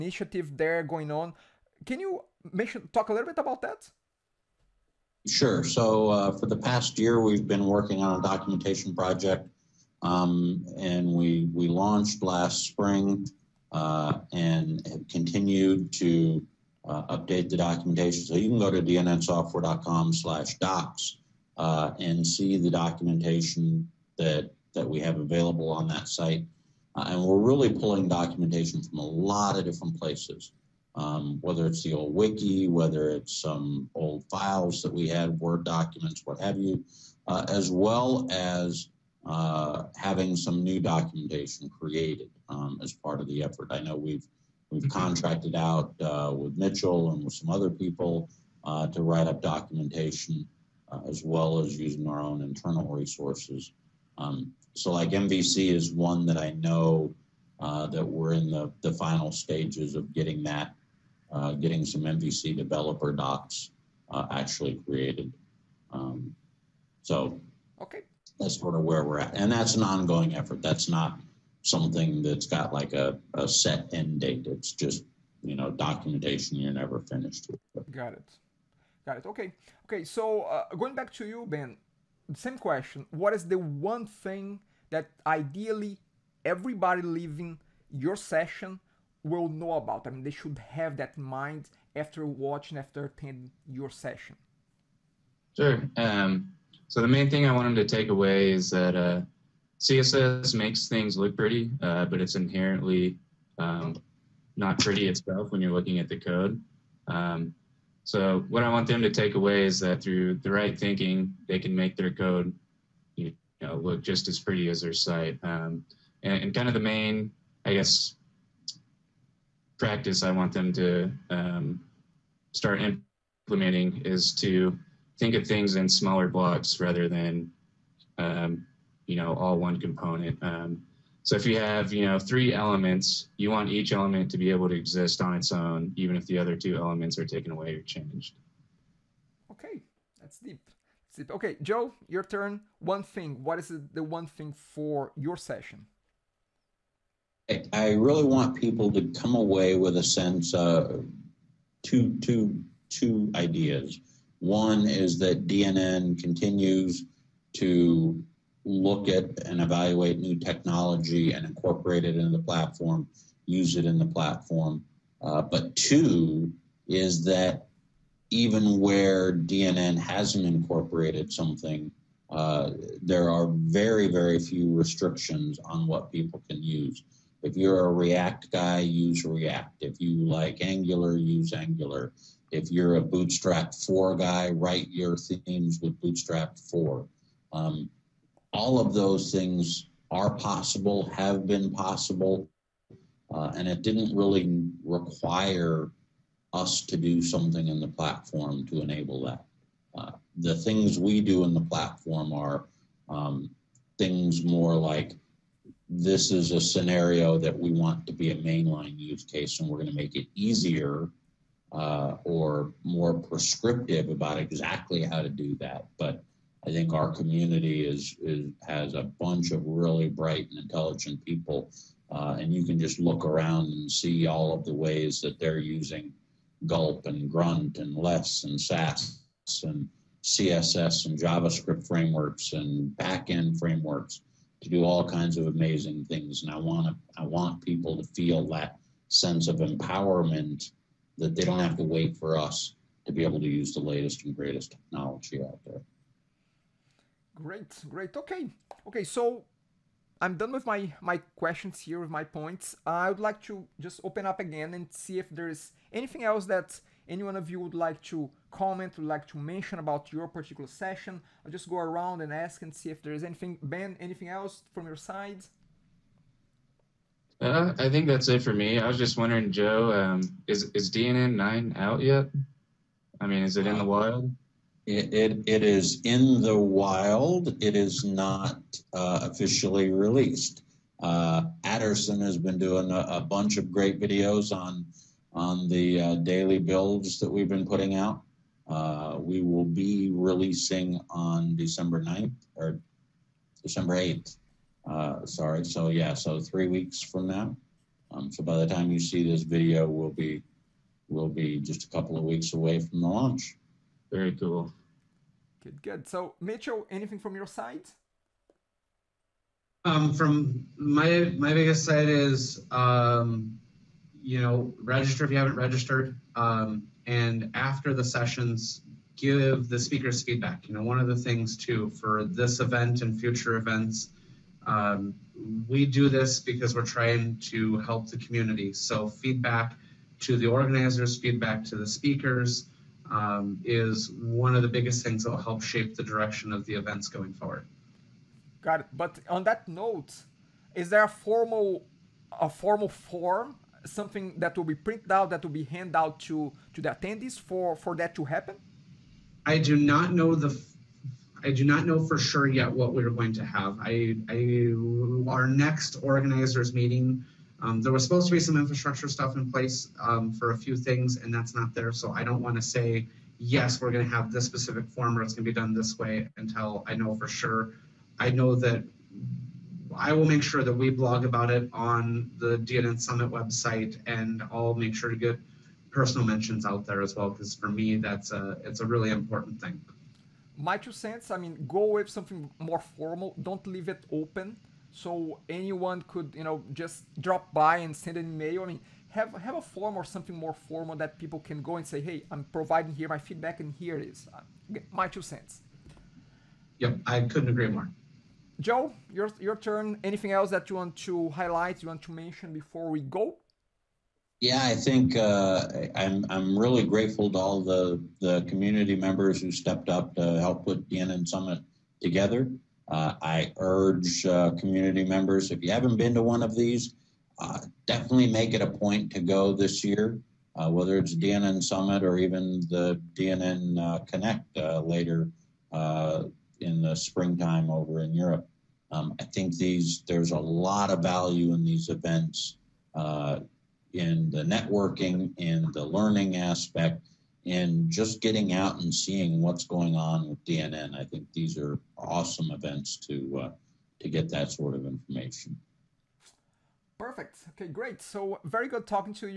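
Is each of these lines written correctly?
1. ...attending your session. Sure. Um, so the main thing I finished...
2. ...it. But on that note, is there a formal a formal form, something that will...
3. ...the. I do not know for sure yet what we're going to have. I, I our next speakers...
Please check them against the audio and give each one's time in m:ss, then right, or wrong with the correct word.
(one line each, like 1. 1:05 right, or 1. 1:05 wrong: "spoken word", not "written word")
1. 1:33 wrong: "wanted", not "finished"
2. 5:38 right
3. 5:50 wrong: "organizers", not "speakers".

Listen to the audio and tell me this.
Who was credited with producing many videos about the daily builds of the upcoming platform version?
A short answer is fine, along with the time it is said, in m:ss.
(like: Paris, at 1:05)
Aderson, at 4:41.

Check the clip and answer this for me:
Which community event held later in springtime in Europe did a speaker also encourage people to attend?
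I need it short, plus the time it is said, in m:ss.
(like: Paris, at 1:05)
DNN Connect, at 7:03.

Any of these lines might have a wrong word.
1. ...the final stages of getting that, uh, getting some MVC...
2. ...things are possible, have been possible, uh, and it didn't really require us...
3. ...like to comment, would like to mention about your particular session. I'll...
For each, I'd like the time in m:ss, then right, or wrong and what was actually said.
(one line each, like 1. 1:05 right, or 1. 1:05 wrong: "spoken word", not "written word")
1. 0:58 right
2. 3:09 right
3. 4:17 right.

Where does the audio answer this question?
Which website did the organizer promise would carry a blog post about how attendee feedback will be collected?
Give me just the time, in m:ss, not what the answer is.
6:12.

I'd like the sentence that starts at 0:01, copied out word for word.
Can you mention talk a little bit about that?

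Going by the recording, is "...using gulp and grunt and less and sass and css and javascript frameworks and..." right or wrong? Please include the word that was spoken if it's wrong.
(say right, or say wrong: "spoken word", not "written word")
right.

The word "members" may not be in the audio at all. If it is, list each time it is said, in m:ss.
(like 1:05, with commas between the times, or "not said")
6:48, 6:55.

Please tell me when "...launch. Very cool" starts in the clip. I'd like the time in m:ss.
5:03.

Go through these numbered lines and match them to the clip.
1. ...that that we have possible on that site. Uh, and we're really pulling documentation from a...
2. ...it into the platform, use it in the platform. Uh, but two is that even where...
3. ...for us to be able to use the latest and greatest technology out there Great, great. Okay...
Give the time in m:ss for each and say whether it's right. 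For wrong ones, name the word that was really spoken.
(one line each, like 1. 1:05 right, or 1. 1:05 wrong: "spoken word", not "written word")
1. 0:24 wrong: "available", not "possible"
2. 2:42 right
3. 4:02 right.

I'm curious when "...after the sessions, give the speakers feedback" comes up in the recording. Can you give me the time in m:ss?
5:17.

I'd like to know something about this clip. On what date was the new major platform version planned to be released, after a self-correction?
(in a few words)
December 8th.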